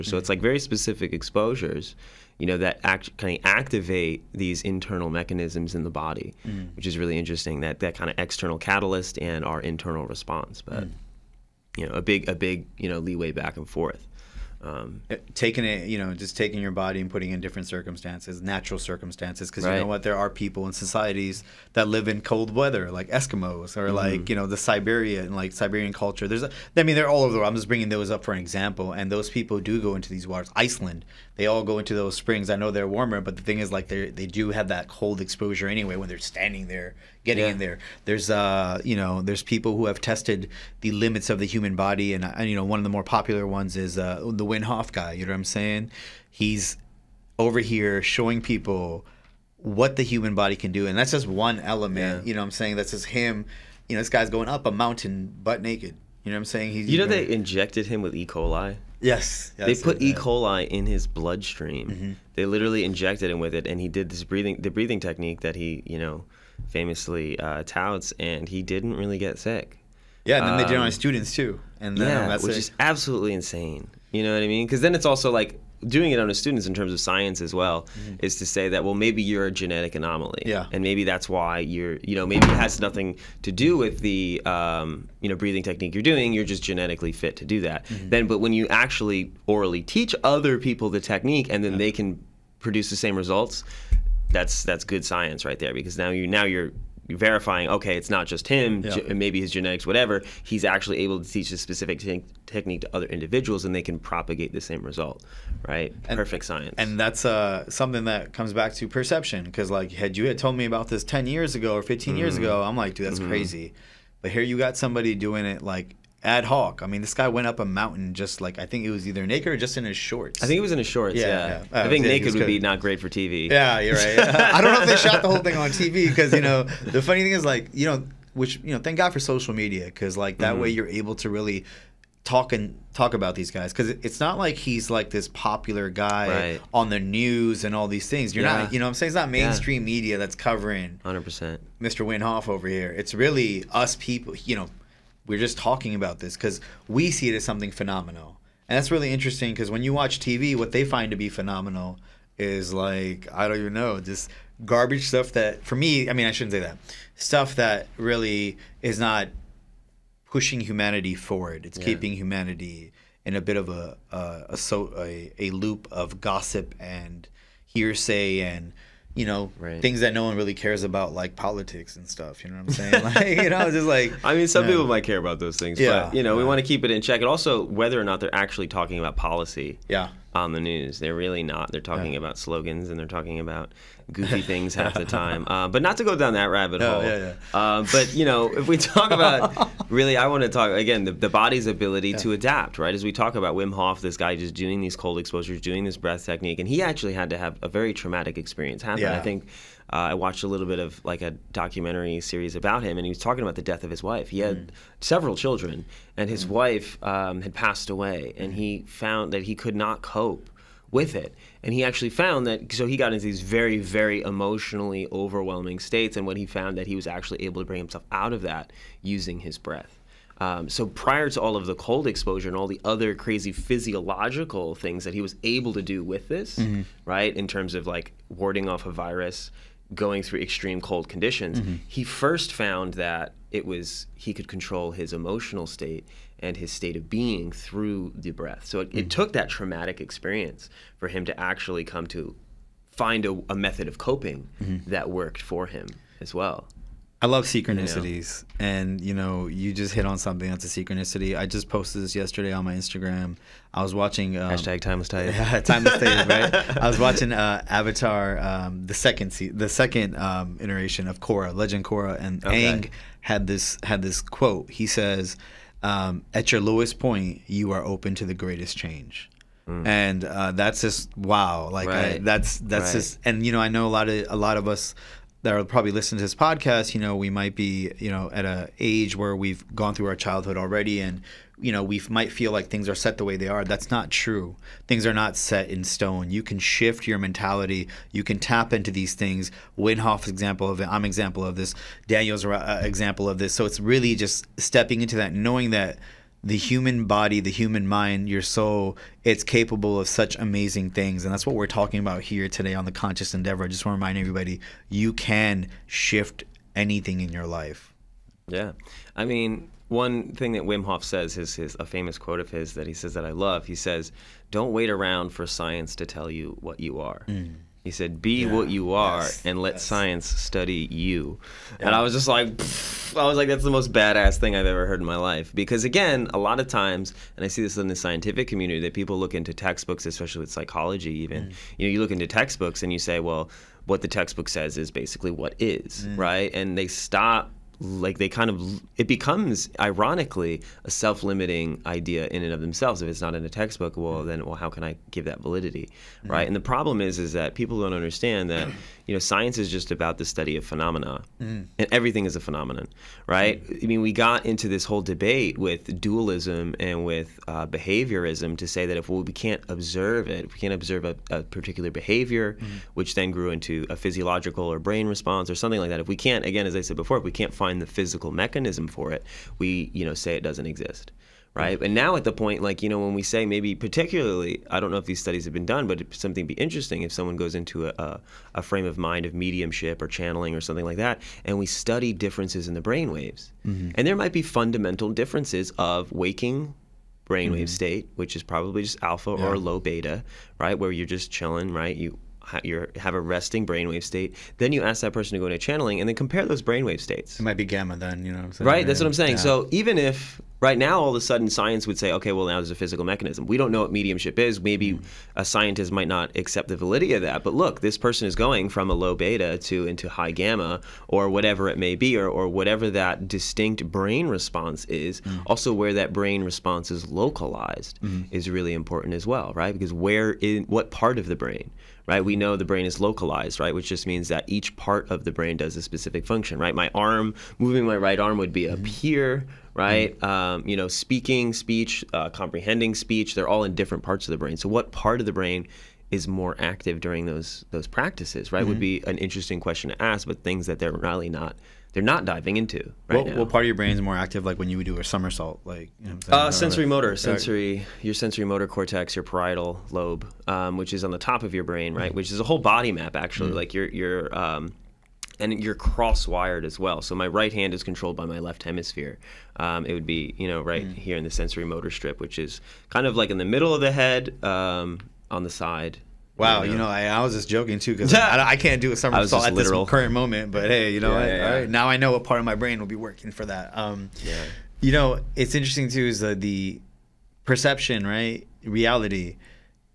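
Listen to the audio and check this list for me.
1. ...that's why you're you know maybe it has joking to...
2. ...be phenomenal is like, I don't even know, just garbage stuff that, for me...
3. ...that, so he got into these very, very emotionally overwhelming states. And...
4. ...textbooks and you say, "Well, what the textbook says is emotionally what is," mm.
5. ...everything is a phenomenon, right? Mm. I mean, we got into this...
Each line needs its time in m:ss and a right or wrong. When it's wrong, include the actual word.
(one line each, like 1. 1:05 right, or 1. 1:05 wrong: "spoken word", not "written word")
1. 1:21 wrong: "nothing", not "joking"
2. 2:31 right
3. 3:32 right
4. 5:32 wrong: "basically", not "emotionally"
5. 5:51 right.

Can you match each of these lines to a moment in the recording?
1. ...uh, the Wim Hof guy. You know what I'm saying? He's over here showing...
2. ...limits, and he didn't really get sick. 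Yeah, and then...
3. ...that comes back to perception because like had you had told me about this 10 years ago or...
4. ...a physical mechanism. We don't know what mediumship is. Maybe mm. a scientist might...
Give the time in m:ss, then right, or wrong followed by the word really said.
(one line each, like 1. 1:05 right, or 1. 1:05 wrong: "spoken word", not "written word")
1. 0:43 right
2. 1:07 wrong: "touts", not "limits"
3. 1:48 right
4. 6:42 right.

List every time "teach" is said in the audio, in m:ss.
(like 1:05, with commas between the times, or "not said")
1:29, 1:41.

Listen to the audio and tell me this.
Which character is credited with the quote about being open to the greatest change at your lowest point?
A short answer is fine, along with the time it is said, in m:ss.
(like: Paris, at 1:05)
Aang, at 4:22.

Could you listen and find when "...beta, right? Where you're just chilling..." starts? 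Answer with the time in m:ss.
6:29.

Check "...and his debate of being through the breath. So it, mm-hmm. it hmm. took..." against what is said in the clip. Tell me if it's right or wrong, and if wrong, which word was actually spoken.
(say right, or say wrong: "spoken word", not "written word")
wrong: "state", not "debate".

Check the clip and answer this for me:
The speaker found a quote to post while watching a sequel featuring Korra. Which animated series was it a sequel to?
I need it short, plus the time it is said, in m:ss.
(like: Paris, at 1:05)
Avatar, at 4:17.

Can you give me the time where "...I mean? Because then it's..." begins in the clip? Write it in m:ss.
1:14.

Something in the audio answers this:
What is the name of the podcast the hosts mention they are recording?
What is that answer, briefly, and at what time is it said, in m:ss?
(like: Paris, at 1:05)
The Conscious Endeavor, at 5:02.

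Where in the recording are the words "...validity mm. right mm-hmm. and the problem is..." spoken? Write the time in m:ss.
5:45.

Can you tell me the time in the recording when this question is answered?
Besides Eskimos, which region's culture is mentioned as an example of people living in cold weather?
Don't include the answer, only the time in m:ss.
0:24.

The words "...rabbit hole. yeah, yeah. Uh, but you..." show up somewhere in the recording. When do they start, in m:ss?
3:06.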